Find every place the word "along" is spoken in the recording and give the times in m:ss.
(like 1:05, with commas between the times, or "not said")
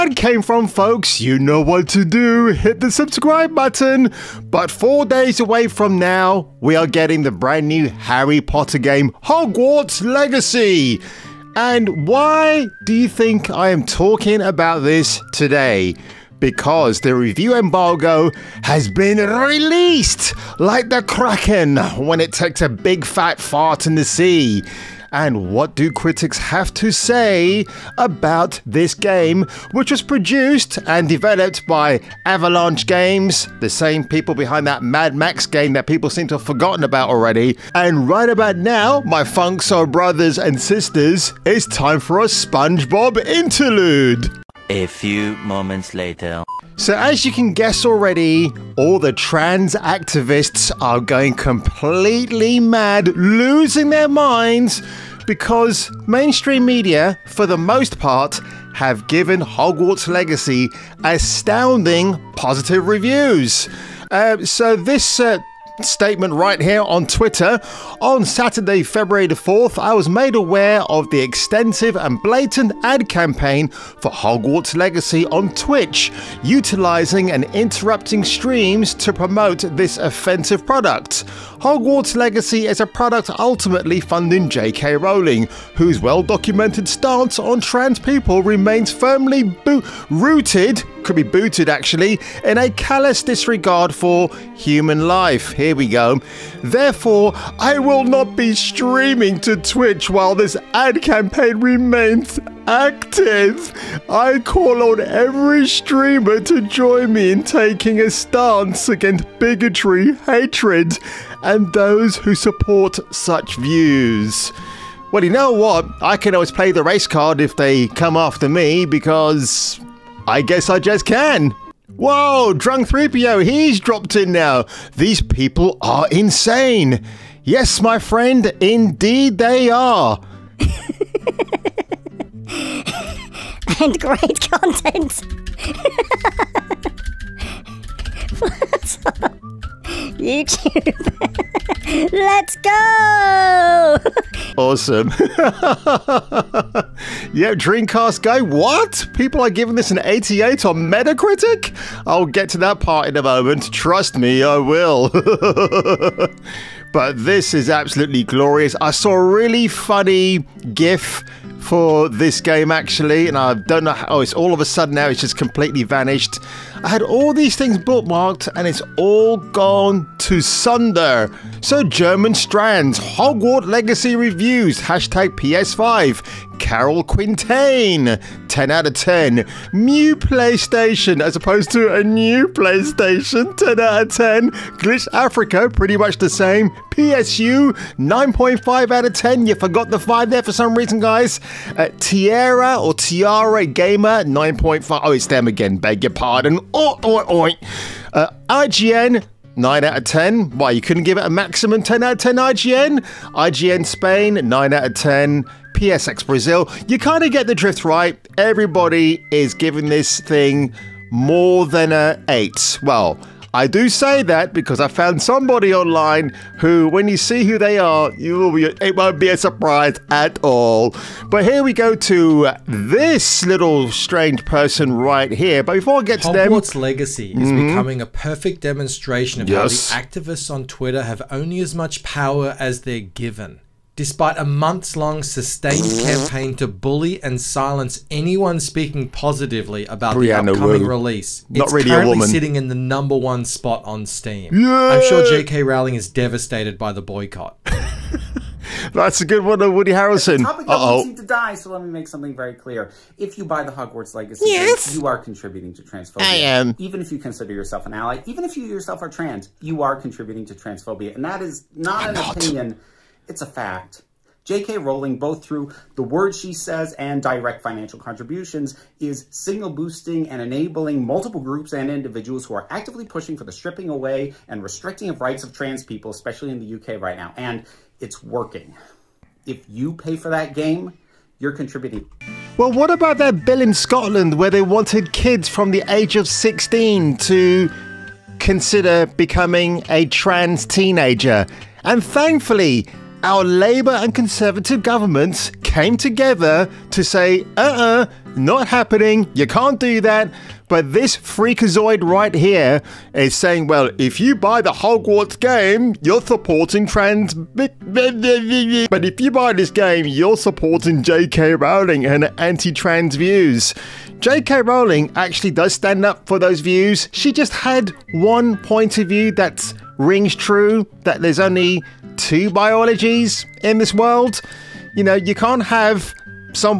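not said.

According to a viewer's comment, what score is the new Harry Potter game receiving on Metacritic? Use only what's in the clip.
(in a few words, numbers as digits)
88.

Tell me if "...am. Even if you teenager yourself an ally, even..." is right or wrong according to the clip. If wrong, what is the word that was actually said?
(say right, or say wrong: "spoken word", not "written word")
wrong: "consider", not "teenager".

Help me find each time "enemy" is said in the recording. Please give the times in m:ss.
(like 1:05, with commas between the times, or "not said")
not said.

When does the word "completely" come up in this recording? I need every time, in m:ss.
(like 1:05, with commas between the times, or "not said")
0:51, 2:45.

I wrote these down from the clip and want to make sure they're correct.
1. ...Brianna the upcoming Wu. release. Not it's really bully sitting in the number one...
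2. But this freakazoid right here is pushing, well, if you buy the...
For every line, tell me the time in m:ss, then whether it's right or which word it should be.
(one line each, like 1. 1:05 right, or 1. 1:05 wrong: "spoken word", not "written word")
1. 4:00 wrong: "currently", not "bully"
2. 5:00 wrong: "saying", not "pushing".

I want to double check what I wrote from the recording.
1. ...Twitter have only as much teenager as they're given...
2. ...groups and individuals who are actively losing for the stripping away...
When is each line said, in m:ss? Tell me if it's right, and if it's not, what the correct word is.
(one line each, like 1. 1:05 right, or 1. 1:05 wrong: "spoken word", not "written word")
1. 3:50 wrong: "power", not "teenager"
2. 4:31 wrong: "pushing", not "losing".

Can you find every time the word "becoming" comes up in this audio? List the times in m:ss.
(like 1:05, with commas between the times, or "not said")
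3:47, 4:49.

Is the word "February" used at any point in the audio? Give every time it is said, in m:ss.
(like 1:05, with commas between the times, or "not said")
1:08.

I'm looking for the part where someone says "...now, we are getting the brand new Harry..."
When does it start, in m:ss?
0:05.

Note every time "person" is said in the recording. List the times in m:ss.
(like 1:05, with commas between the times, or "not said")
3:44.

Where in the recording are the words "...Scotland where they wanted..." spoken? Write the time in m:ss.
4:43.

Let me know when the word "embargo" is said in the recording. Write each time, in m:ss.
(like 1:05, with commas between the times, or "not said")
0:17.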